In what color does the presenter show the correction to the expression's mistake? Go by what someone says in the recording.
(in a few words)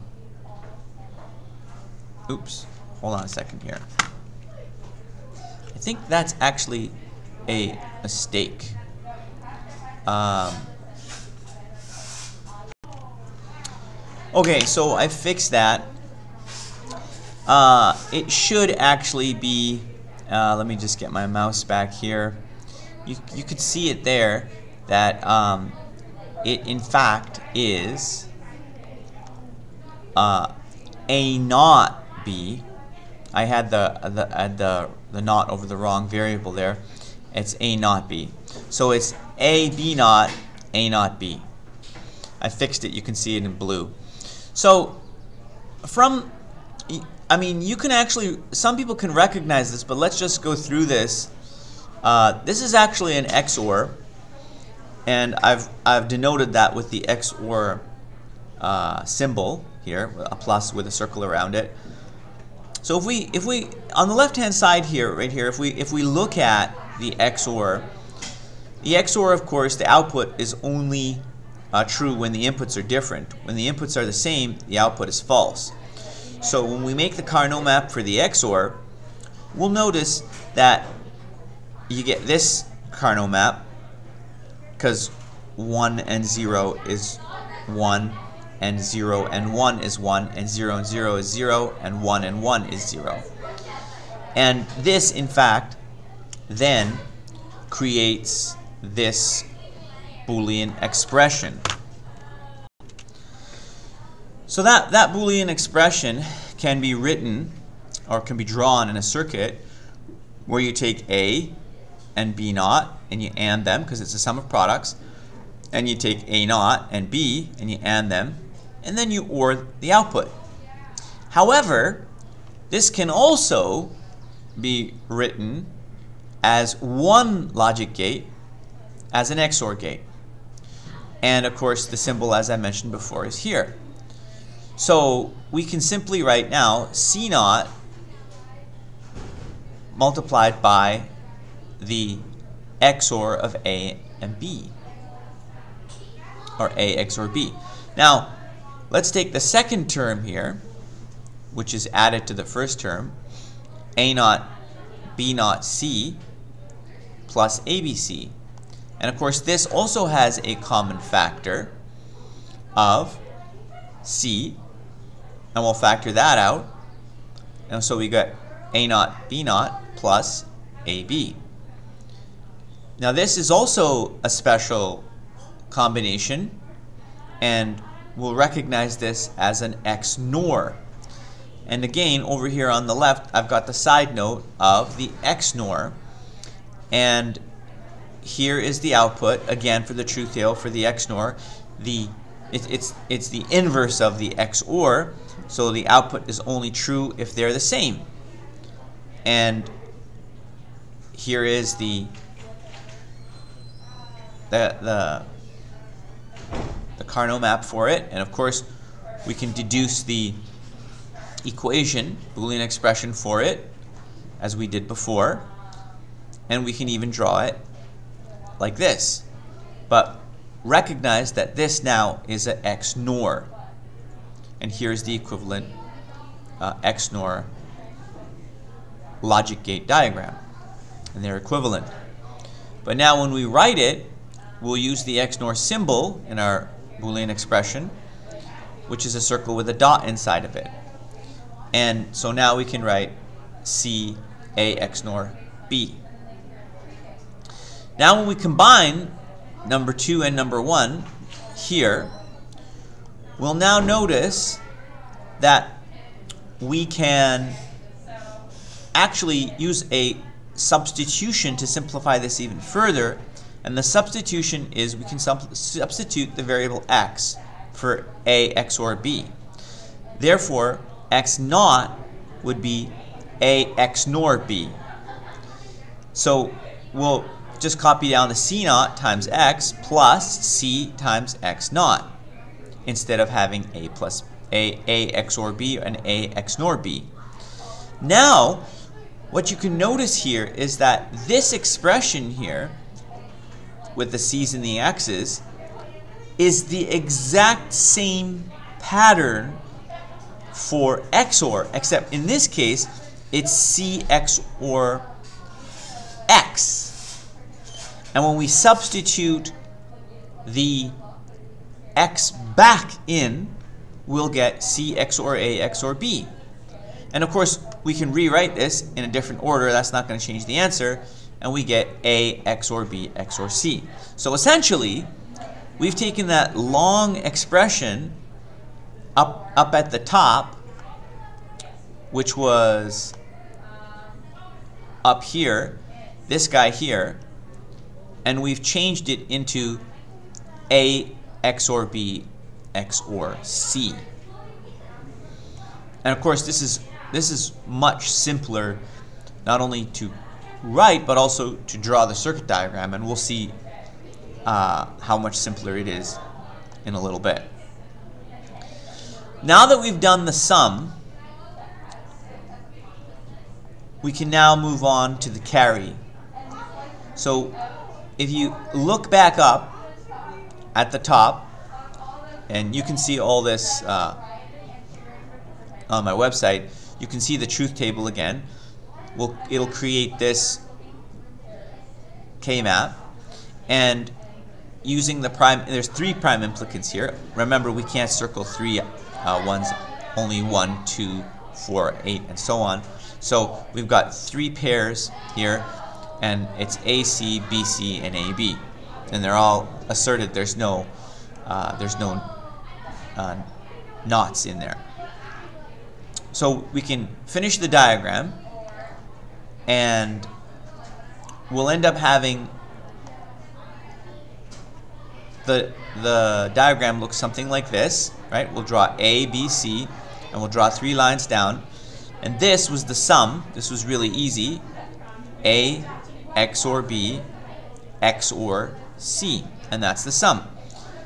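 blue.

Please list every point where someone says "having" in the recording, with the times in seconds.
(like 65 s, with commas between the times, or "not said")
283 s, 411 s.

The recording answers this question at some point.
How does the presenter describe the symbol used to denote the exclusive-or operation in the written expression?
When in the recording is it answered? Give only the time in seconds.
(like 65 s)
60 s.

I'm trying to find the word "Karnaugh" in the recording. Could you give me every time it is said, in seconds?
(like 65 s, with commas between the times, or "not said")
77 s, 82 s, 207 s.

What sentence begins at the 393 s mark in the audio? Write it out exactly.
So we've got three pairs here, and it's AC, BC, and AB.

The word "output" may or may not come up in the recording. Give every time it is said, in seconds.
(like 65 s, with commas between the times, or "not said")
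69 s, 74 s, 119 s, 188 s, 195 s.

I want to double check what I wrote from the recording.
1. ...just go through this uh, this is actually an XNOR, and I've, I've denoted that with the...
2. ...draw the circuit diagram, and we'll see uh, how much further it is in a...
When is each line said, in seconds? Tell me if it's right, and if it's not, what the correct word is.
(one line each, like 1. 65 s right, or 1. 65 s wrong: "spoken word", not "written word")
1. 50 s wrong: "XOR", not "XNOR"
2. 351 s wrong: "simpler", not "further".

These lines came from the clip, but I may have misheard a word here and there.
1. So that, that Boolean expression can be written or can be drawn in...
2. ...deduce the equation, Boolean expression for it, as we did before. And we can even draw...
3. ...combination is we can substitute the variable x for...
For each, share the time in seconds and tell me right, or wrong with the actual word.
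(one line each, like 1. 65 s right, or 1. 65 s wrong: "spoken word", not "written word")
1. 104 s right
2. 209 s right
3. 263 s wrong: "substitution", not "combination".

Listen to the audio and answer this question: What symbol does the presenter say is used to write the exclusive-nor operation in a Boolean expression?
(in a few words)
a circle with a dot.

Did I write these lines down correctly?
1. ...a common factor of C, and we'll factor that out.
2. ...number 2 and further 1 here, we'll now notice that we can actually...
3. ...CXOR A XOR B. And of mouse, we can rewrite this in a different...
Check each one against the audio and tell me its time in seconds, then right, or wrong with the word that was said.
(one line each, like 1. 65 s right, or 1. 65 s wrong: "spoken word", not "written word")
1. 160 s right
2. 249 s wrong: "number", not "further"
3. 314 s wrong: "course", not "mouse".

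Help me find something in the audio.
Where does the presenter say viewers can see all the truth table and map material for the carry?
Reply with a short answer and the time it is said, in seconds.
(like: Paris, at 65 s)
my website, at 376 s.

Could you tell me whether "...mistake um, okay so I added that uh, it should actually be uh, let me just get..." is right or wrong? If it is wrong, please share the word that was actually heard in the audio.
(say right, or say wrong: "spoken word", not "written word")
wrong: "fixed", not "added".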